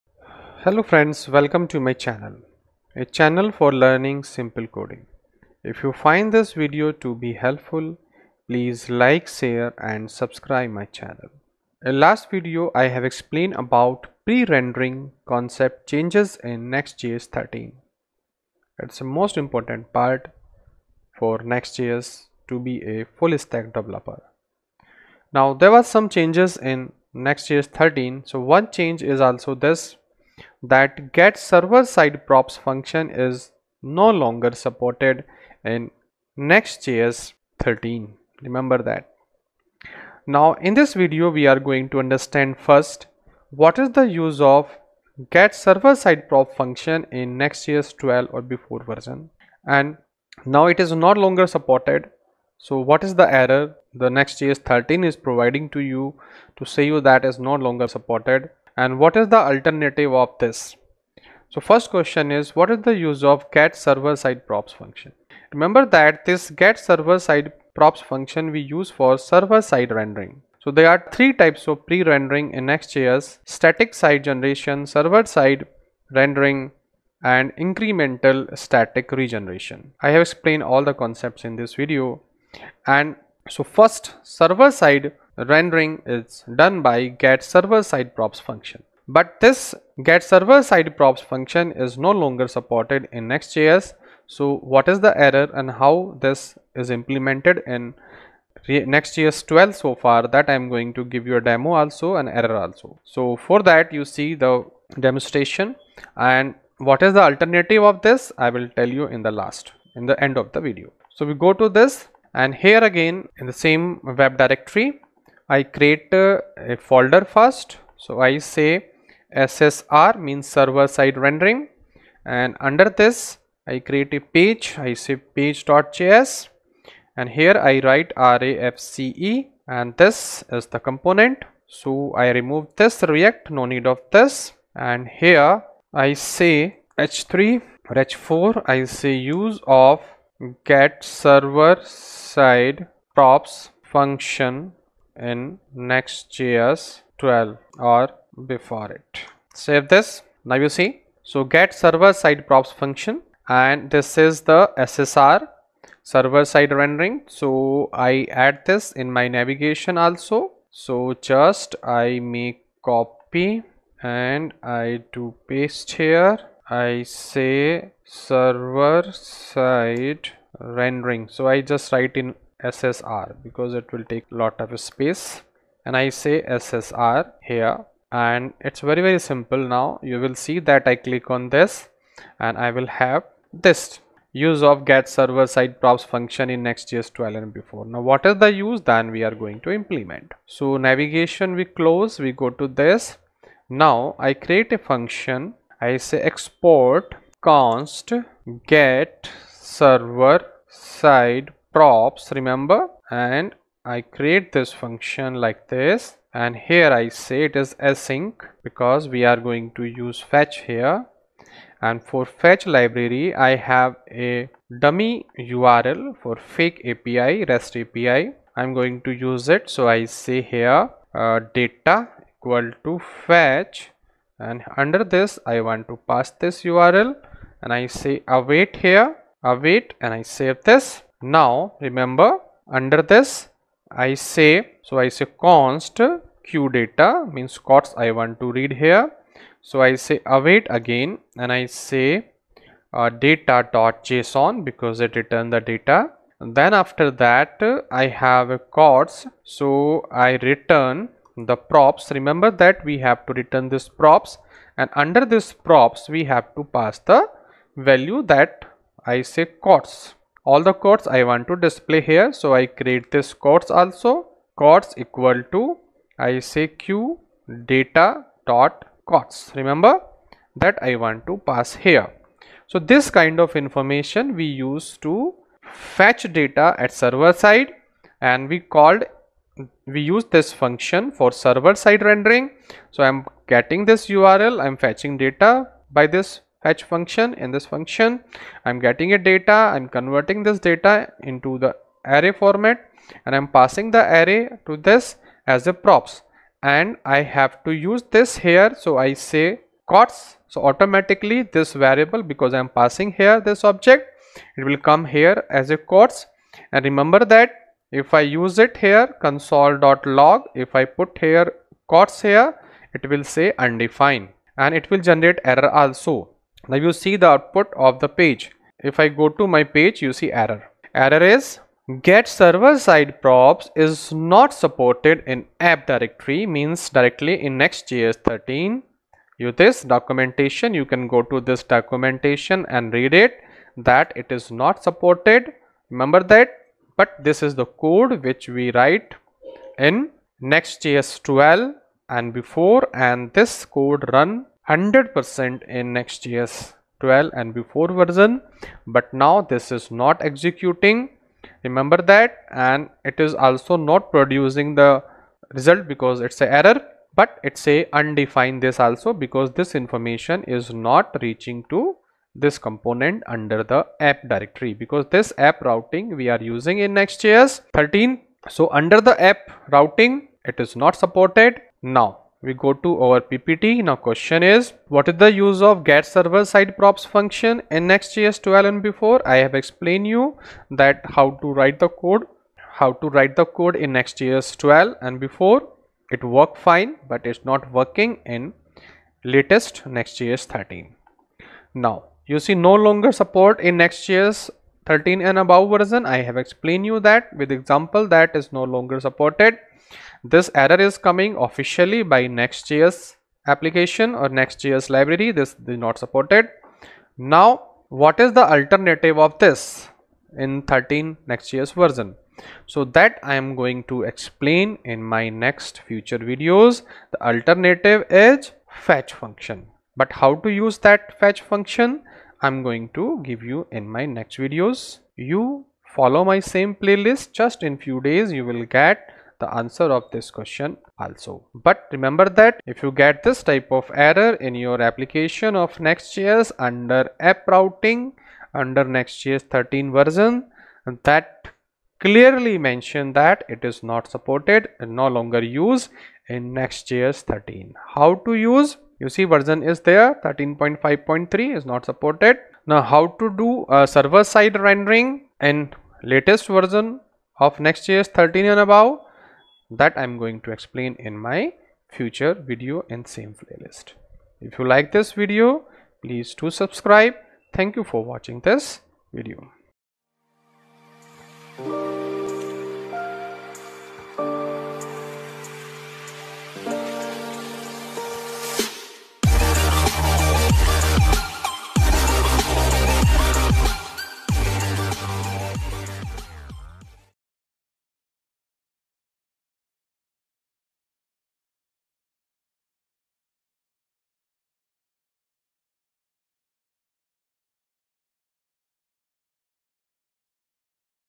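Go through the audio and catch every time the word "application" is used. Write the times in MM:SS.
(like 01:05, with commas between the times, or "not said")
06:43, 07:14.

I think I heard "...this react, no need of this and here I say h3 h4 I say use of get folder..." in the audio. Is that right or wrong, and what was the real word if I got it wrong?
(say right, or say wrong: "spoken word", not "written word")
wrong: "server", not "folder".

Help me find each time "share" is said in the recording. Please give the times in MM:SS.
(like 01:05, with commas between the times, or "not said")
00:09.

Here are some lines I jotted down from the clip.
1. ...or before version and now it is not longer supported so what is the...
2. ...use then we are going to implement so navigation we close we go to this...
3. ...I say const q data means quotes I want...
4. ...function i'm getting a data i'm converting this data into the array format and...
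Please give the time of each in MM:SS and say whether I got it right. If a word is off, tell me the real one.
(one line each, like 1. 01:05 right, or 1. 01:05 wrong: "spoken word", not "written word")
1. 00:48 right
2. 03:08 right
3. 03:54 right
4. 04:47 right.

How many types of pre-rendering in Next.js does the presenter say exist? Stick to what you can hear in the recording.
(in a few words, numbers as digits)
3.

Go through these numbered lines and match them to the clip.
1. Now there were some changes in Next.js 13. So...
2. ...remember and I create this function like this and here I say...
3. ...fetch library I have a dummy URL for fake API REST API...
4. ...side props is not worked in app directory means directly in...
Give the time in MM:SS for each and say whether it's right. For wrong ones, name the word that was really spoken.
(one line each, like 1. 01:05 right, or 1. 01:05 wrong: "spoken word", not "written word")
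1. 00:25 right
2. 03:22 right
3. 03:32 right
4. 05:22 wrong: "supported", not "worked".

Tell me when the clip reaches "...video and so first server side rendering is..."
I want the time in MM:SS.
01:21.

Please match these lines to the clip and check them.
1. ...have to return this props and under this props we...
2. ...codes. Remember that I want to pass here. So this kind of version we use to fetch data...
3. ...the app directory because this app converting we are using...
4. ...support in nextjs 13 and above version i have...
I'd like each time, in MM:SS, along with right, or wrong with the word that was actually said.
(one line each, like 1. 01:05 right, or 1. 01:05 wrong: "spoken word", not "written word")
1. 04:12 right
2. 04:29 wrong: "information", not "version"
3. 06:03 wrong: "routing", not "converting"
4. 06:33 right.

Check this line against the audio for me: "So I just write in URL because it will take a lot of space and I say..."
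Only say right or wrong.
wrong.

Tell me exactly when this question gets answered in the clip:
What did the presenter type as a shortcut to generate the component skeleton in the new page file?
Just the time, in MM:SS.
02:08.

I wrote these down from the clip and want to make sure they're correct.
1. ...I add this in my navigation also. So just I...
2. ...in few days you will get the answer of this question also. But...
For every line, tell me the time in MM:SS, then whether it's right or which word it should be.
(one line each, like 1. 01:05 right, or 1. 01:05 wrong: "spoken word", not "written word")
1. 02:37 right
2. 07:07 right.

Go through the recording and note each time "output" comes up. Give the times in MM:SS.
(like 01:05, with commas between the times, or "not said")
05:17.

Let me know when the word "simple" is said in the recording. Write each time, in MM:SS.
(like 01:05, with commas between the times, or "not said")
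00:04, 02:59.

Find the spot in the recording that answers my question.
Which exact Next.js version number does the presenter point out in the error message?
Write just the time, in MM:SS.
07:30.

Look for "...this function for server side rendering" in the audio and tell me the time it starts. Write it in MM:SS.
04:40.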